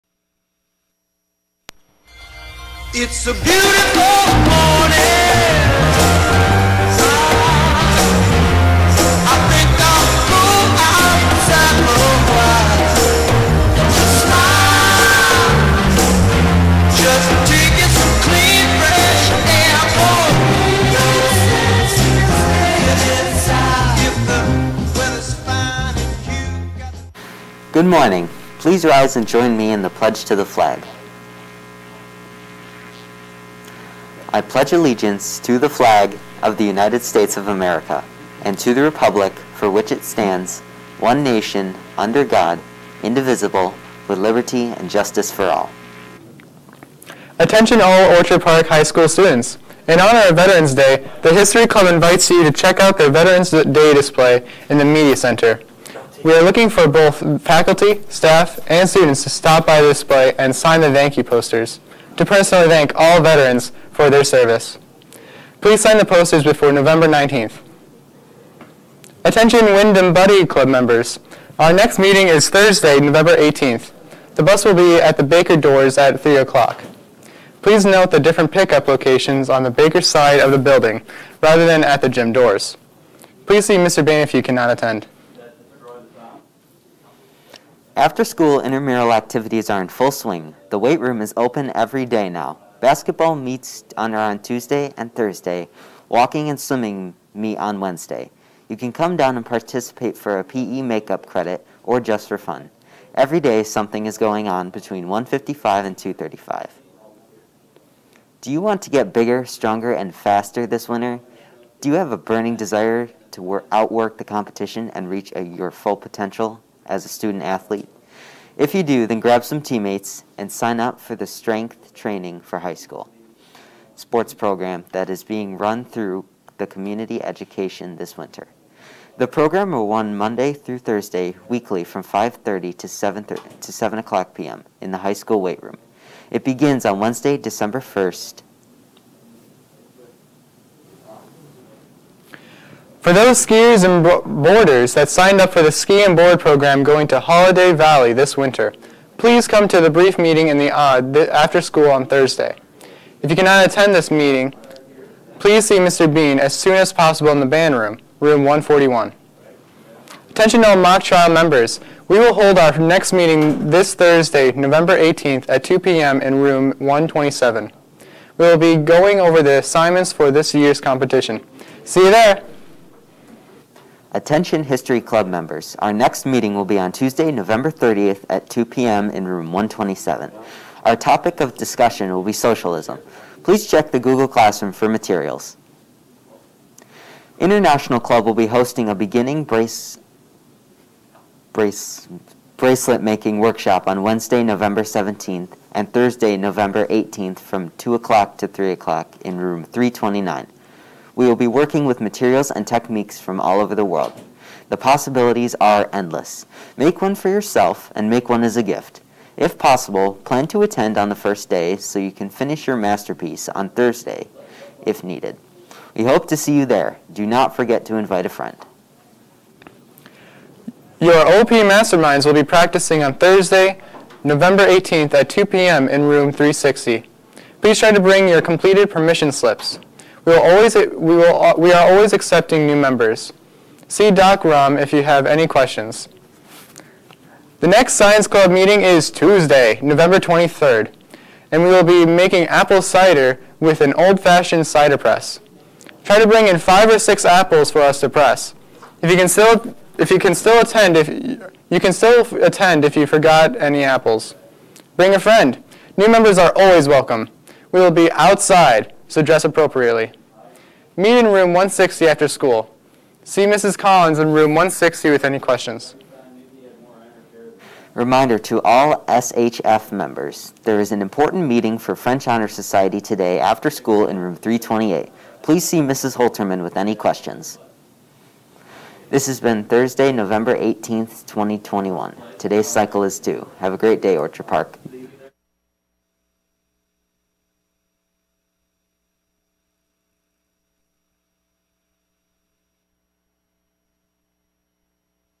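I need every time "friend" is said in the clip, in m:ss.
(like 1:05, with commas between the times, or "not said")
3:38, 4:15.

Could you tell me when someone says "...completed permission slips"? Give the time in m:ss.
3:48.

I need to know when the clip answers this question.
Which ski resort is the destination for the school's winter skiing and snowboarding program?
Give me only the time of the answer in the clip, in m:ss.
2:27.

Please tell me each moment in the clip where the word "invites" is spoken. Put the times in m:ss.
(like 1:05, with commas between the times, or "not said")
0:51, 3:37.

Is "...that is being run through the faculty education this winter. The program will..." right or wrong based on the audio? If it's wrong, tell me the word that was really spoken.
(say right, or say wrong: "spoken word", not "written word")
wrong: "community", not "faculty".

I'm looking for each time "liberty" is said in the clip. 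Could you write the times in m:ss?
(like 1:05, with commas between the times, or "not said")
0:44.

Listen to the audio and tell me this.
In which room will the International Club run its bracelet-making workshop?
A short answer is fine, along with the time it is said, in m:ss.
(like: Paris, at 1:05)
Room 329, at 3:19.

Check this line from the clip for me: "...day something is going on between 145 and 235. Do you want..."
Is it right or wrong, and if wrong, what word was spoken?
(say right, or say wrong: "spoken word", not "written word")
wrong: "155", not "145".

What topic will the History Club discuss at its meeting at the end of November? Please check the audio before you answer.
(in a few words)
Socialism.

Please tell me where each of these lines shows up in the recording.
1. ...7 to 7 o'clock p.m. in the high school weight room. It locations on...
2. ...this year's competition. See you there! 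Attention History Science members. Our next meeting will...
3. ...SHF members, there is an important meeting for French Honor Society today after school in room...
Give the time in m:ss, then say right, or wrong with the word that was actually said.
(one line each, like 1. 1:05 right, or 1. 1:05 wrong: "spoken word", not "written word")
1. 2:12 wrong: "begins", not "locations"
2. 2:50 wrong: "Club", not "Science"
3. 4:29 right.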